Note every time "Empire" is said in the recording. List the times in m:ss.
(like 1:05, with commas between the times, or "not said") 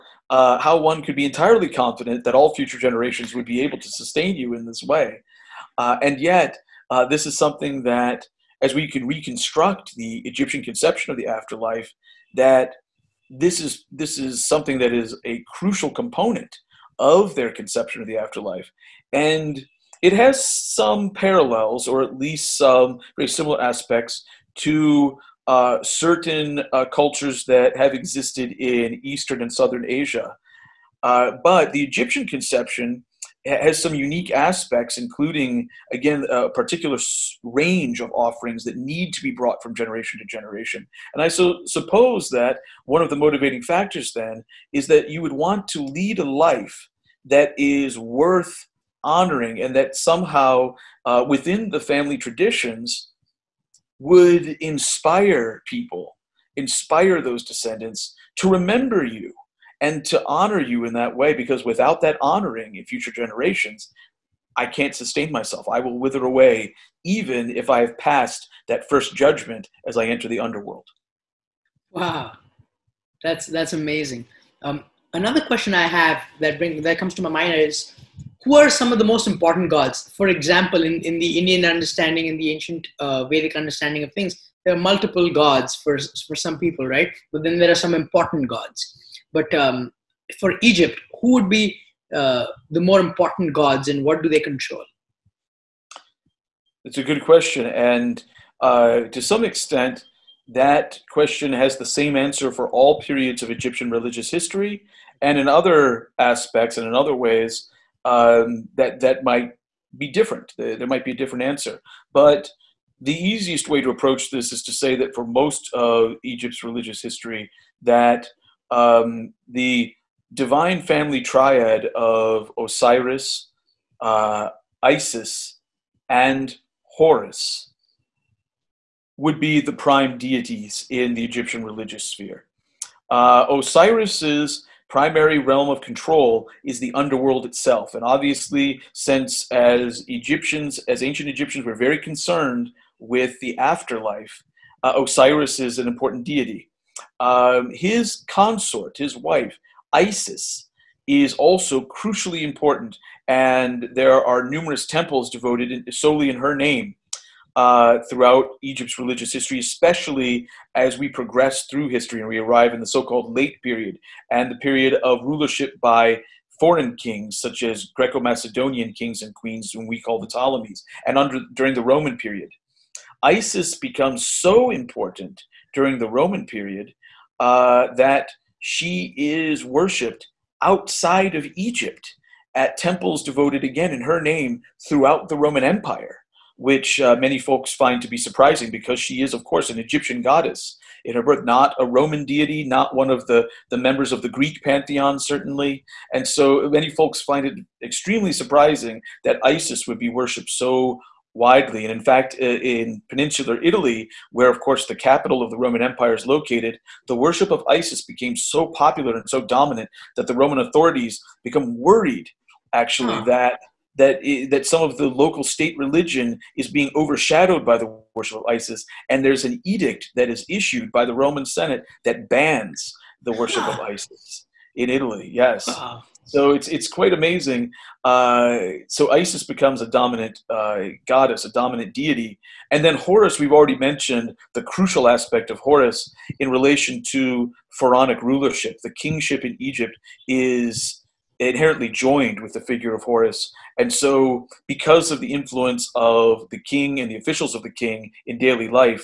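3:05, 3:25.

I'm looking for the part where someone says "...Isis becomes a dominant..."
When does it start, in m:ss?
3:49.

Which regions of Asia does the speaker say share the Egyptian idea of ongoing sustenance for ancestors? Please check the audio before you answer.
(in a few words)
Eastern and Southern Asia.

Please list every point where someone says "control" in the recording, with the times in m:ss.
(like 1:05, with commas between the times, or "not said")
1:34, 2:15.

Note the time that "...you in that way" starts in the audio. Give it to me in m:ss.
1:00.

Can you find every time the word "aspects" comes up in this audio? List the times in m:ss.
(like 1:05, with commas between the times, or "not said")
0:23, 0:34, 1:46, 3:55.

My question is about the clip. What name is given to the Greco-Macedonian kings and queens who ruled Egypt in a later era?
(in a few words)
the Ptolemies.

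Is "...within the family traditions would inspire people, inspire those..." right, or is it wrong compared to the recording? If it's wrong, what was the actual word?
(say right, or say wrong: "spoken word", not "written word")
right.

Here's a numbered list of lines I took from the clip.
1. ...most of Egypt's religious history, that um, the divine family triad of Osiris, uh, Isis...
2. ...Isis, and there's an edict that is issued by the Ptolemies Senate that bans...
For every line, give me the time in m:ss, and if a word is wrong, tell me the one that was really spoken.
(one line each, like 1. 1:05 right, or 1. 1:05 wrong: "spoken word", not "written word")
1. 1:55 right
2. 3:38 wrong: "Roman", not "Ptolemies".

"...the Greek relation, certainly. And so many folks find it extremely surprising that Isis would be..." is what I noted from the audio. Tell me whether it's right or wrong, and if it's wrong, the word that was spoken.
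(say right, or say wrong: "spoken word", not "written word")
wrong: "pantheon", not "relation".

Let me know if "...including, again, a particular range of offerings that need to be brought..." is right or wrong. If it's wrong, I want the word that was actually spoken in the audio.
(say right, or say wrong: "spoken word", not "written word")
right.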